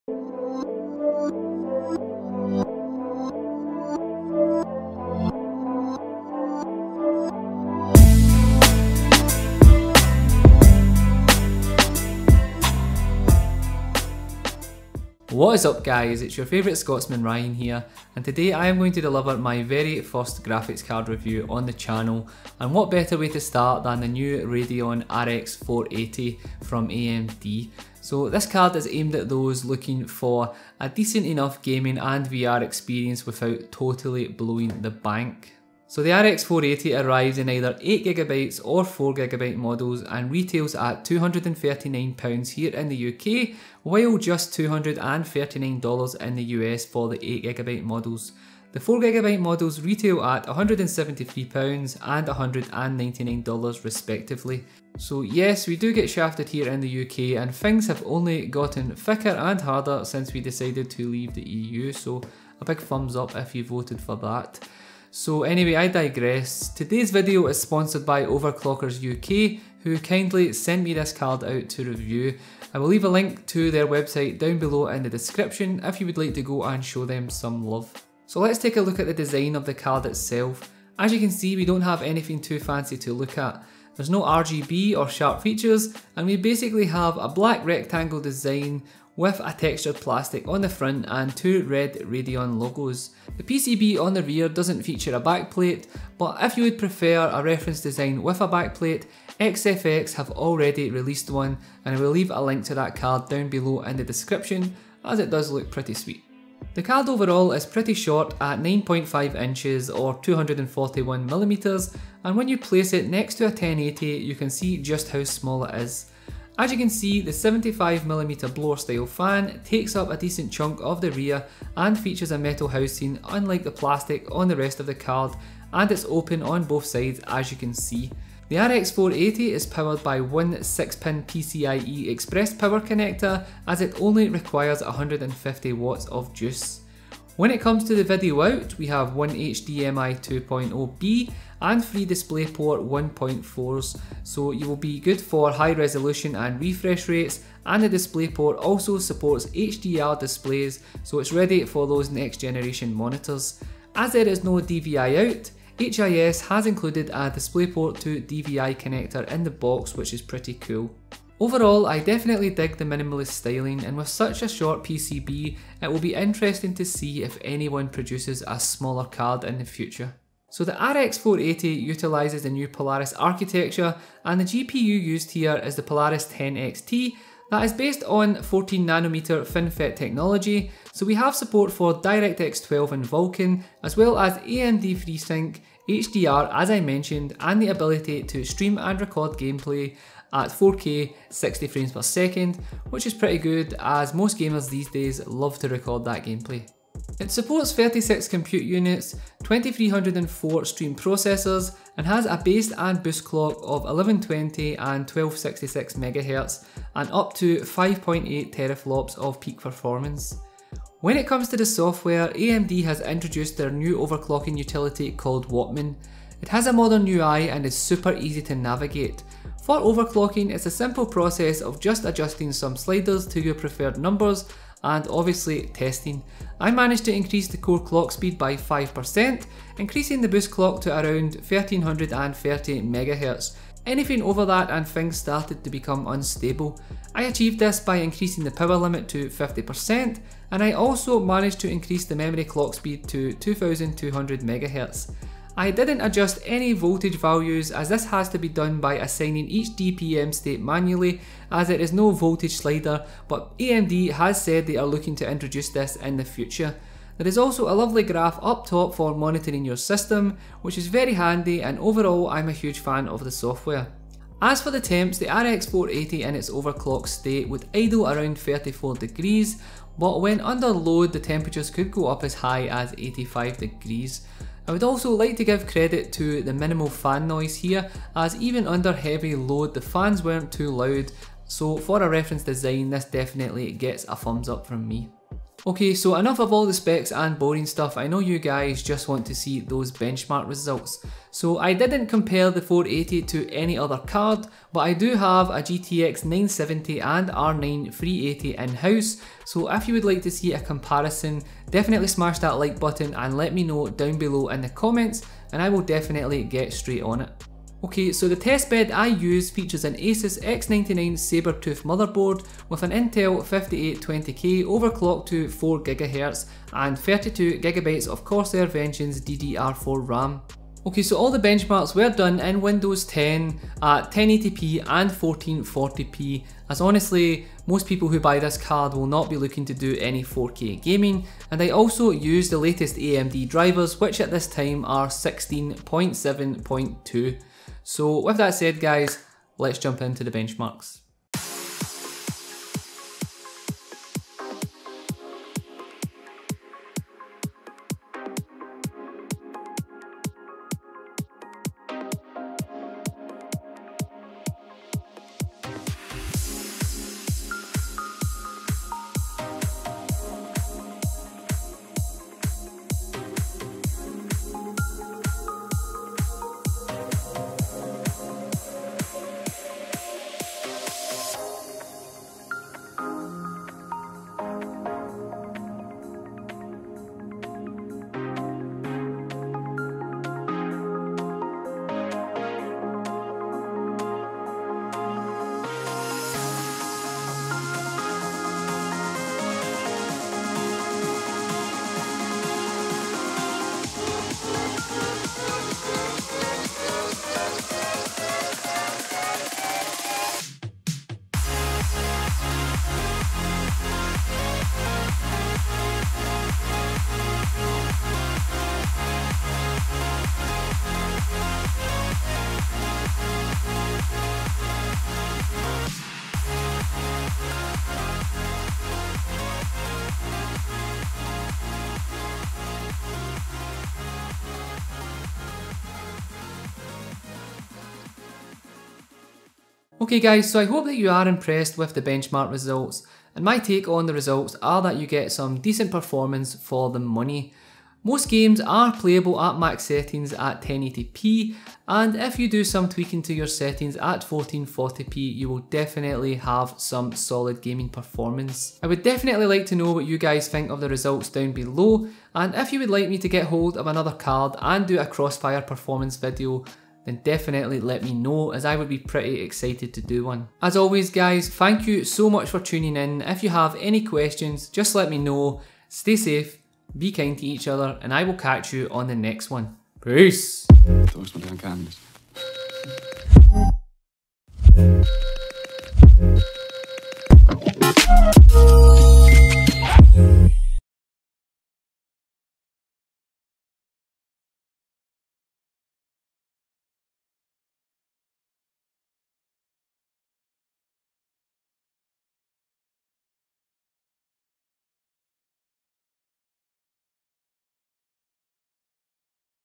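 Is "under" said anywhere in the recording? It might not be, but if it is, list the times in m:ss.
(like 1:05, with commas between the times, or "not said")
4:30, 4:38.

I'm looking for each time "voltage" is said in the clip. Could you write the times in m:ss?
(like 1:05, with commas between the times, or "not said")
4:06, 4:12.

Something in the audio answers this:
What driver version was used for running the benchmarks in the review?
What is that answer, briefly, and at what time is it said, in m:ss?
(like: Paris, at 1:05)
16.7.2, at 5:35.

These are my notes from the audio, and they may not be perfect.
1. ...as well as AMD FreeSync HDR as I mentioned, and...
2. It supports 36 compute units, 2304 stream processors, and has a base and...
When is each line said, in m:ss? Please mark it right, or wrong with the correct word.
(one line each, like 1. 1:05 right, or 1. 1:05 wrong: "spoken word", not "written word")
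1. 3:03 right
2. 3:17 right.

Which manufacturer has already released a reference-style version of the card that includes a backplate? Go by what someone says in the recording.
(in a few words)
XFX.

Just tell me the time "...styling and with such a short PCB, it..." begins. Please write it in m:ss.
2:43.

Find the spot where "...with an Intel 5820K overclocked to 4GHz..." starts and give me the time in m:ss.
5:12.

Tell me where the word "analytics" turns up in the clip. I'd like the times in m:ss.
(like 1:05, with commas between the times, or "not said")
not said.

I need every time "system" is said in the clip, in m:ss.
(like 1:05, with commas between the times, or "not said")
4:19.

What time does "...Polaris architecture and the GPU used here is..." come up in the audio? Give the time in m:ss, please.
2:52.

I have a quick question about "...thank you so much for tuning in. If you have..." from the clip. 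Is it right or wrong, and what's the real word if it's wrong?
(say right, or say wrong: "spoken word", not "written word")
right.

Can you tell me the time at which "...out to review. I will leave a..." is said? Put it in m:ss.
1:11.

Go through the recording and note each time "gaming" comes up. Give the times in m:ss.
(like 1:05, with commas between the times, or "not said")
0:31, 5:30, 7:27.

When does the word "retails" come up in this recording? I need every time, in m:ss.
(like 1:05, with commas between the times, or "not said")
0:40, 0:49.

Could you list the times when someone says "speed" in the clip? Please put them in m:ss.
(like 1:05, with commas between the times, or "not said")
3:48, 4:02.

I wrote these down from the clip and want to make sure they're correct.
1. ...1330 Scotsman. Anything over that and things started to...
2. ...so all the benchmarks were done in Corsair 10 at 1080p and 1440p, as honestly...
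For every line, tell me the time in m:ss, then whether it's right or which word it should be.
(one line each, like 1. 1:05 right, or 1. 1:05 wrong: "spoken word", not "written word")
1. 3:51 wrong: "MHz", not "Scotsman"
2. 5:21 wrong: "Windows", not "Corsair".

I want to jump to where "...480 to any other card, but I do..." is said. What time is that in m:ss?
4:52.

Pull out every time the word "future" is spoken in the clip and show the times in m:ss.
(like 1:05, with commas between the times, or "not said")
2:49, 4:16.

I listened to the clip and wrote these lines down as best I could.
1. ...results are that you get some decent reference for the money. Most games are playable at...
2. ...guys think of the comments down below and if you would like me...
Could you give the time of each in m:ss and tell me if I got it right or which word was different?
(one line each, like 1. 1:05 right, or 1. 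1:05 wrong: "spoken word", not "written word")
1. 7:14 wrong: "performance", not "reference"
2. 7:30 wrong: "results", not "comments".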